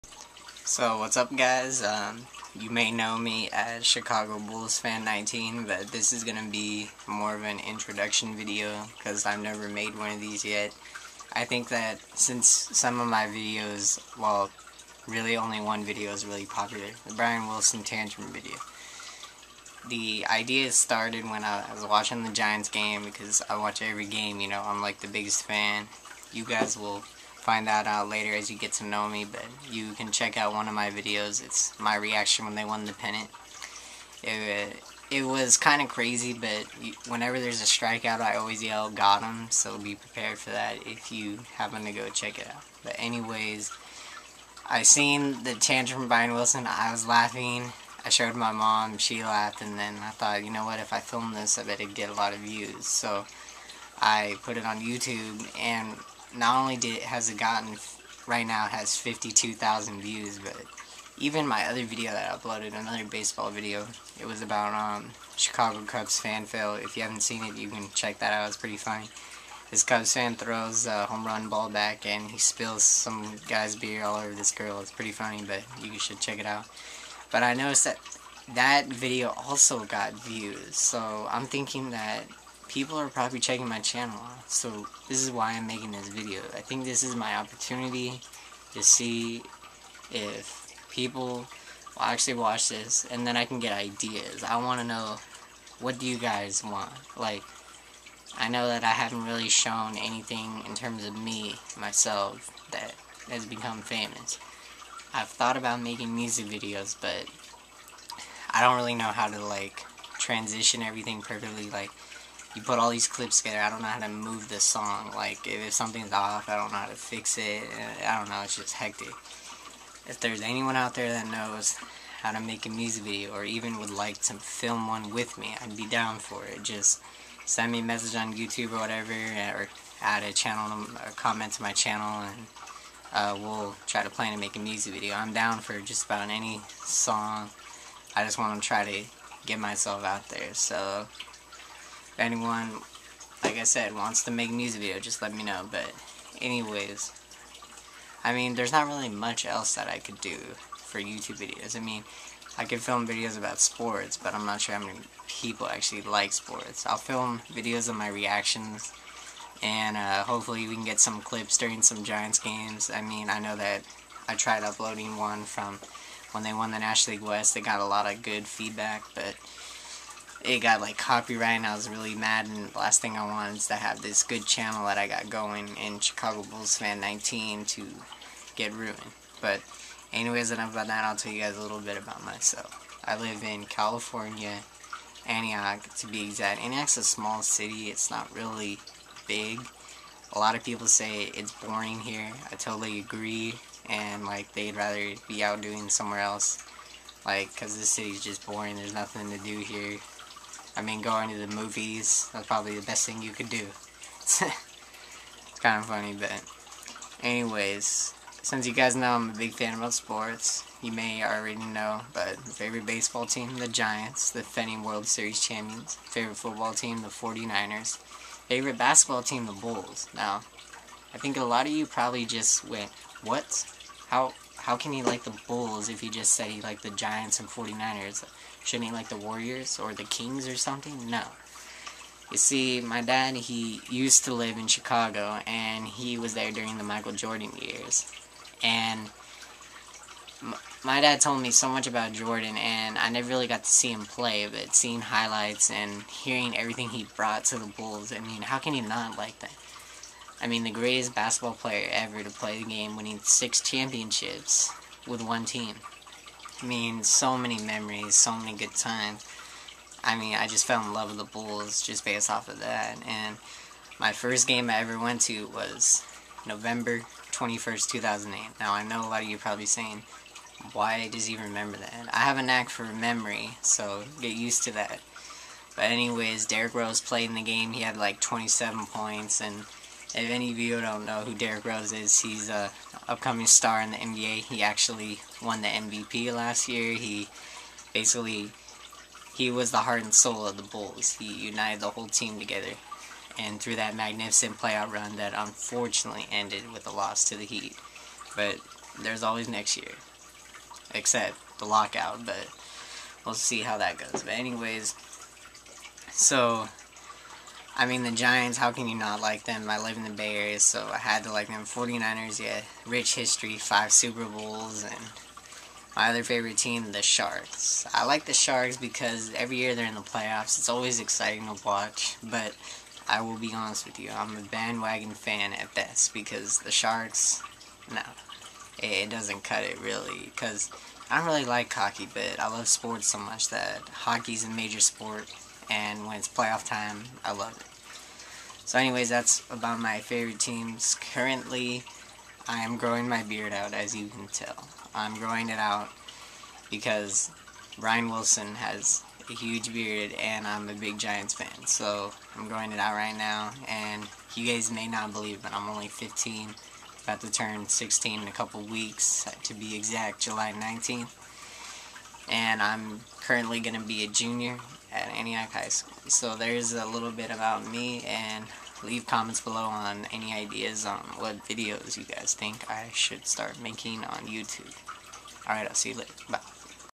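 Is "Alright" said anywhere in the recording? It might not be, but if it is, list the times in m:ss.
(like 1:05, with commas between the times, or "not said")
6:15.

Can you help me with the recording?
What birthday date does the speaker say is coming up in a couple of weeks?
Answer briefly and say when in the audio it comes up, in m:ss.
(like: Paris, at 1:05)
July 19th, at 6:00.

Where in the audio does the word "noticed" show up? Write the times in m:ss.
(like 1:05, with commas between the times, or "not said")
1:17.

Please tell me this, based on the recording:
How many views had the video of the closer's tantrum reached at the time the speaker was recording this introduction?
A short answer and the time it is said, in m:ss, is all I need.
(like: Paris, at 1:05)
52,000, at 0:58.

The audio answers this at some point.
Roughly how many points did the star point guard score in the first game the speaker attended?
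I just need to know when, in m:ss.
4:38.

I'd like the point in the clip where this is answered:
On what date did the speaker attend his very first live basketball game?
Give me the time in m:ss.
4:26.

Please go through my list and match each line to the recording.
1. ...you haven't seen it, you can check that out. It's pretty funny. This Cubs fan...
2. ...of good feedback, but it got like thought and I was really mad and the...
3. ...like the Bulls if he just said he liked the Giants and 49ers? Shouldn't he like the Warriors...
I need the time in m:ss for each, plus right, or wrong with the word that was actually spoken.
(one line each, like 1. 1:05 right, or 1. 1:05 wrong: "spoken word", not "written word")
1. 1:06 right
2. 2:48 wrong: "copyright", not "thought"
3. 3:45 right.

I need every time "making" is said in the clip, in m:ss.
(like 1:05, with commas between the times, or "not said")
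1:25, 1:45, 6:13.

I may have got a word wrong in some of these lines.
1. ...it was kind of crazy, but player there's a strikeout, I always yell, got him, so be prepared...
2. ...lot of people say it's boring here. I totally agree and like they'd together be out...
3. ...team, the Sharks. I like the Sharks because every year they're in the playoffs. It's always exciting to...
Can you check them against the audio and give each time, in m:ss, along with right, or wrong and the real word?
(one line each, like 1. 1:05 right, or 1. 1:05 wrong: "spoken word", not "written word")
1. 0:35 wrong: "whenever", not "player"
2. 3:10 wrong: "rather", not "together"
3. 5:16 right.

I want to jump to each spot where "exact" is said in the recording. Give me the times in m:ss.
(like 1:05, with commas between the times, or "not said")
3:06, 5:59.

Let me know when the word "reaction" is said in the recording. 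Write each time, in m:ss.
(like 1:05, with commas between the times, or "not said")
0:31, 2:38.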